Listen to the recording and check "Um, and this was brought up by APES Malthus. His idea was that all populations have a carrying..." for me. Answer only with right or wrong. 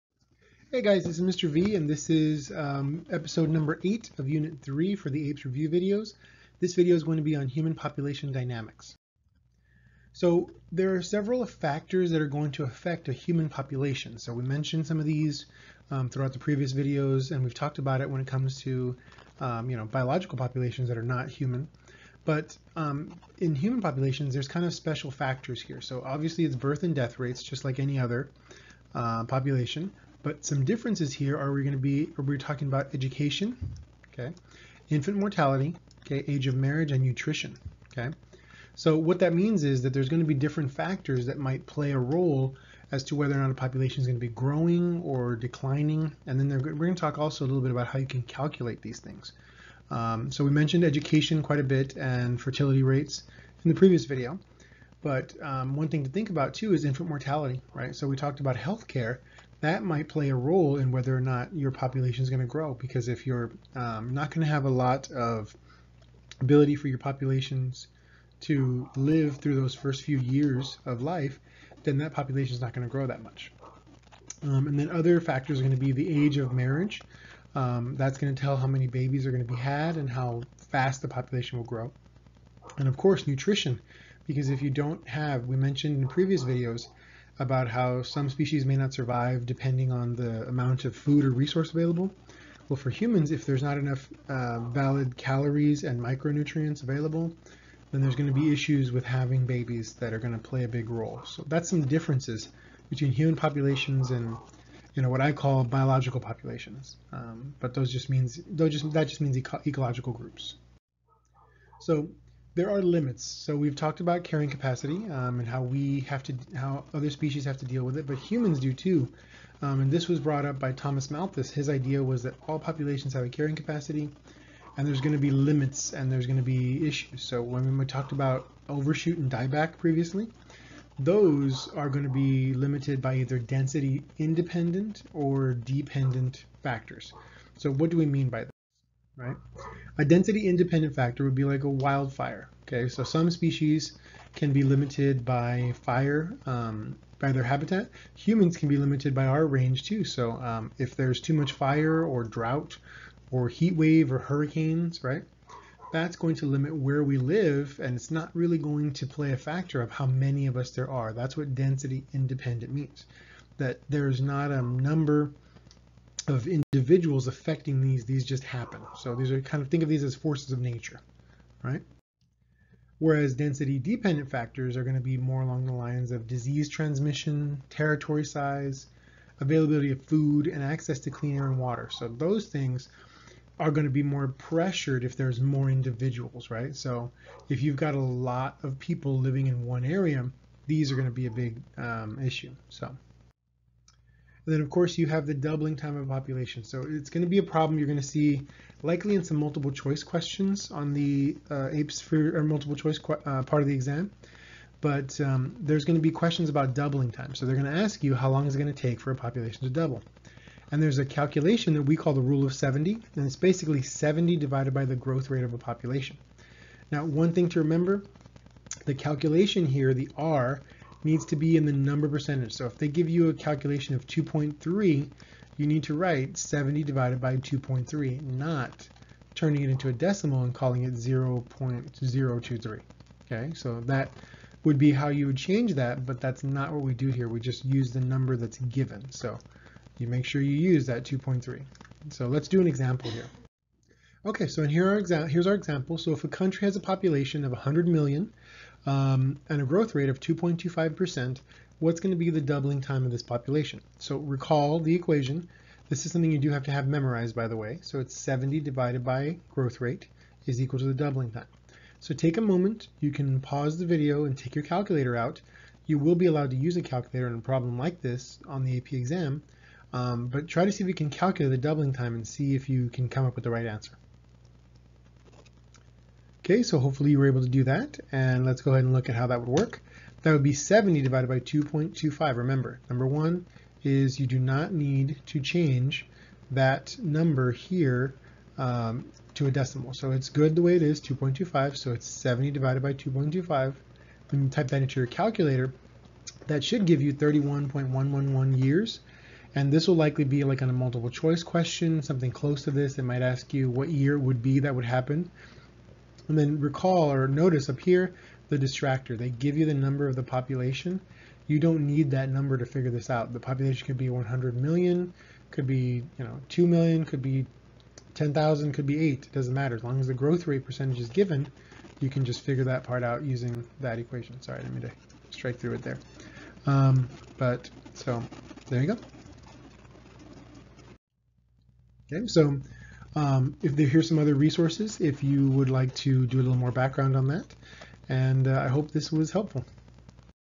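wrong.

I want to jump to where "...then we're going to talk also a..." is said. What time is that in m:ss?
0:46.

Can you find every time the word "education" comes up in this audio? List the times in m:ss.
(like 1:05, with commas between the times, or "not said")
0:32, 0:50.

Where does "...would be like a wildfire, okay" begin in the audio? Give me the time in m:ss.
2:21.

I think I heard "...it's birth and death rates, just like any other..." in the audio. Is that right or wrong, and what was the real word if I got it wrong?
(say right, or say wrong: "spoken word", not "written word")
right.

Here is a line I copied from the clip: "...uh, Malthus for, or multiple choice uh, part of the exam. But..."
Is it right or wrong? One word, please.
wrong.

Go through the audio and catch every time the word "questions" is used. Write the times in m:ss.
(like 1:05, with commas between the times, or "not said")
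3:20, 3:26, 5:01.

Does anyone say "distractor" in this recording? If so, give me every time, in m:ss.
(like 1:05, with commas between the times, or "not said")
5:08.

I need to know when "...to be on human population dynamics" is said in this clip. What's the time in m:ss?
0:07.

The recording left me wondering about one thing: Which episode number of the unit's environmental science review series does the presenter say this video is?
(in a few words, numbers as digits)
8.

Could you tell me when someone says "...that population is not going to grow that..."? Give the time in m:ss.
1:11.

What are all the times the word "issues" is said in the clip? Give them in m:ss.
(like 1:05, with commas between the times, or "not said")
1:38, 2:06, 3:12.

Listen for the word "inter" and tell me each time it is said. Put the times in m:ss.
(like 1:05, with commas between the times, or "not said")
not said.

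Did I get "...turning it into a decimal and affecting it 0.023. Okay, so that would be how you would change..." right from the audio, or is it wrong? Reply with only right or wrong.
wrong.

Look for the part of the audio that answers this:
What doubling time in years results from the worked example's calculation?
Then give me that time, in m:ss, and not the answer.
4:57.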